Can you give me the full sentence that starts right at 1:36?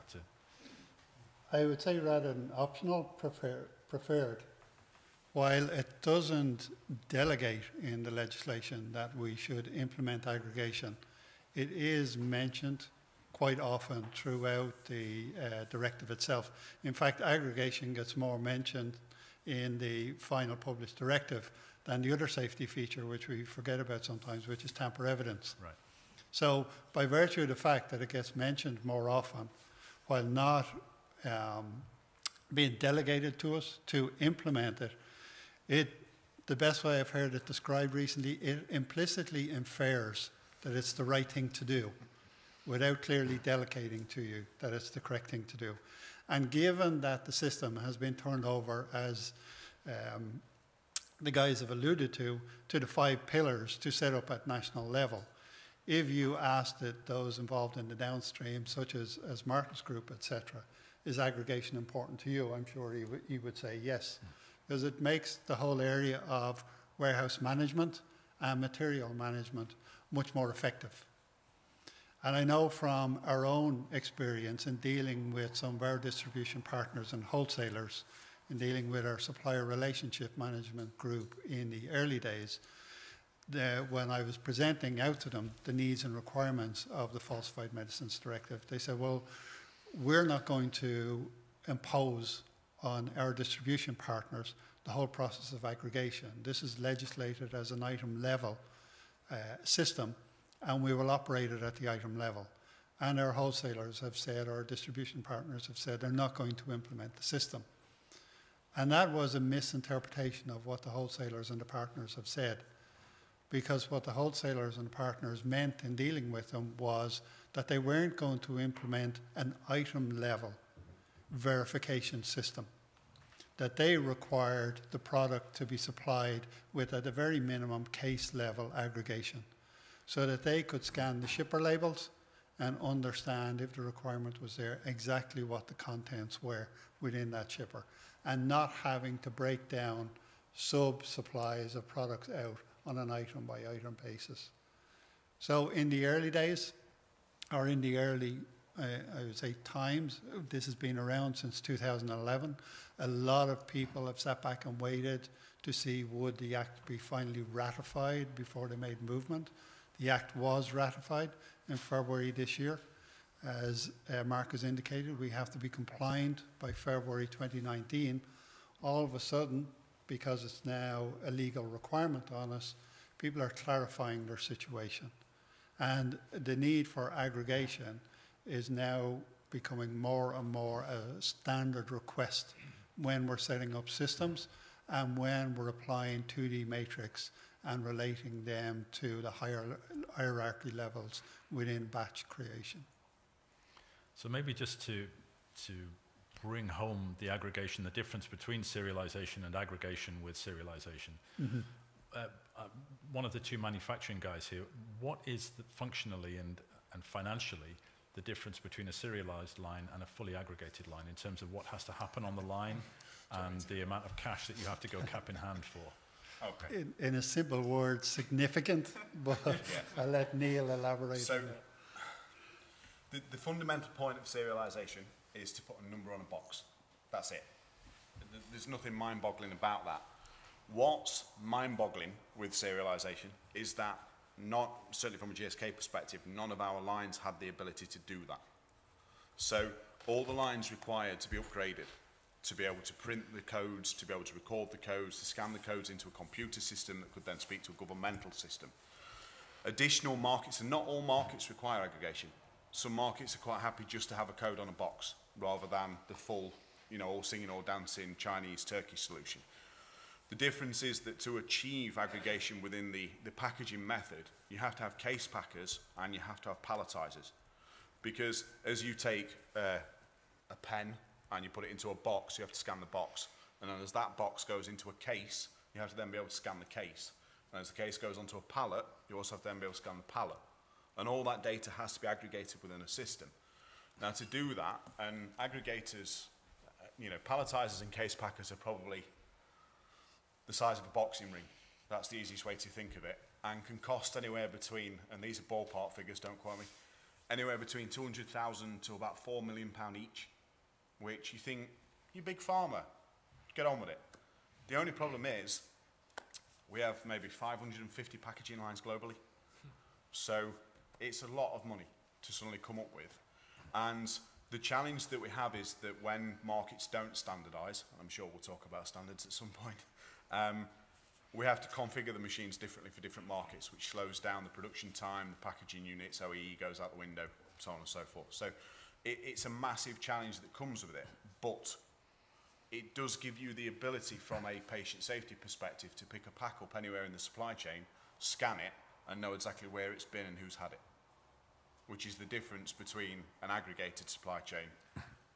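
This is legislated as an item level uh, system and we will operate it at the item level.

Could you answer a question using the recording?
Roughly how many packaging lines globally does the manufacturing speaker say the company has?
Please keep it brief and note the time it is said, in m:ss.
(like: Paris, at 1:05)
550, at 5:07.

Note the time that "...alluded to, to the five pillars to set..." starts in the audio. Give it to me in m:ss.
0:51.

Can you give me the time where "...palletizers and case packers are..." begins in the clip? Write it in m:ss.
4:47.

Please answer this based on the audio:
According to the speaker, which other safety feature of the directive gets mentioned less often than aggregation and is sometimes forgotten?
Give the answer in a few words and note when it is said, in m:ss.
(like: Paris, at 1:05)
Tamper evidence, at 0:24.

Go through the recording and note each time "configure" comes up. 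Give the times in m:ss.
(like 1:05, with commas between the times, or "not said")
5:21.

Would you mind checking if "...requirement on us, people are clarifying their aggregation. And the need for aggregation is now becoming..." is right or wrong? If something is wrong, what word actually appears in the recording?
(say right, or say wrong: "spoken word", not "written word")
wrong: "situation", not "aggregation".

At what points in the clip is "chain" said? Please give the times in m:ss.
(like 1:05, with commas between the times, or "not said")
5:37, 5:44.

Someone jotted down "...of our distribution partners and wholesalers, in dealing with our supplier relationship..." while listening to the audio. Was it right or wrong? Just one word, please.
right.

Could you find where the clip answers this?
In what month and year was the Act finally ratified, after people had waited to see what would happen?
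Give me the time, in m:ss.
2:41.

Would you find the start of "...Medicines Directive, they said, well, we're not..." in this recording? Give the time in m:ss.
1:27.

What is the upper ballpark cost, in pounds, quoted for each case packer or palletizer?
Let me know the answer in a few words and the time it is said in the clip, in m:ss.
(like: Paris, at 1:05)
£4 million, at 4:59.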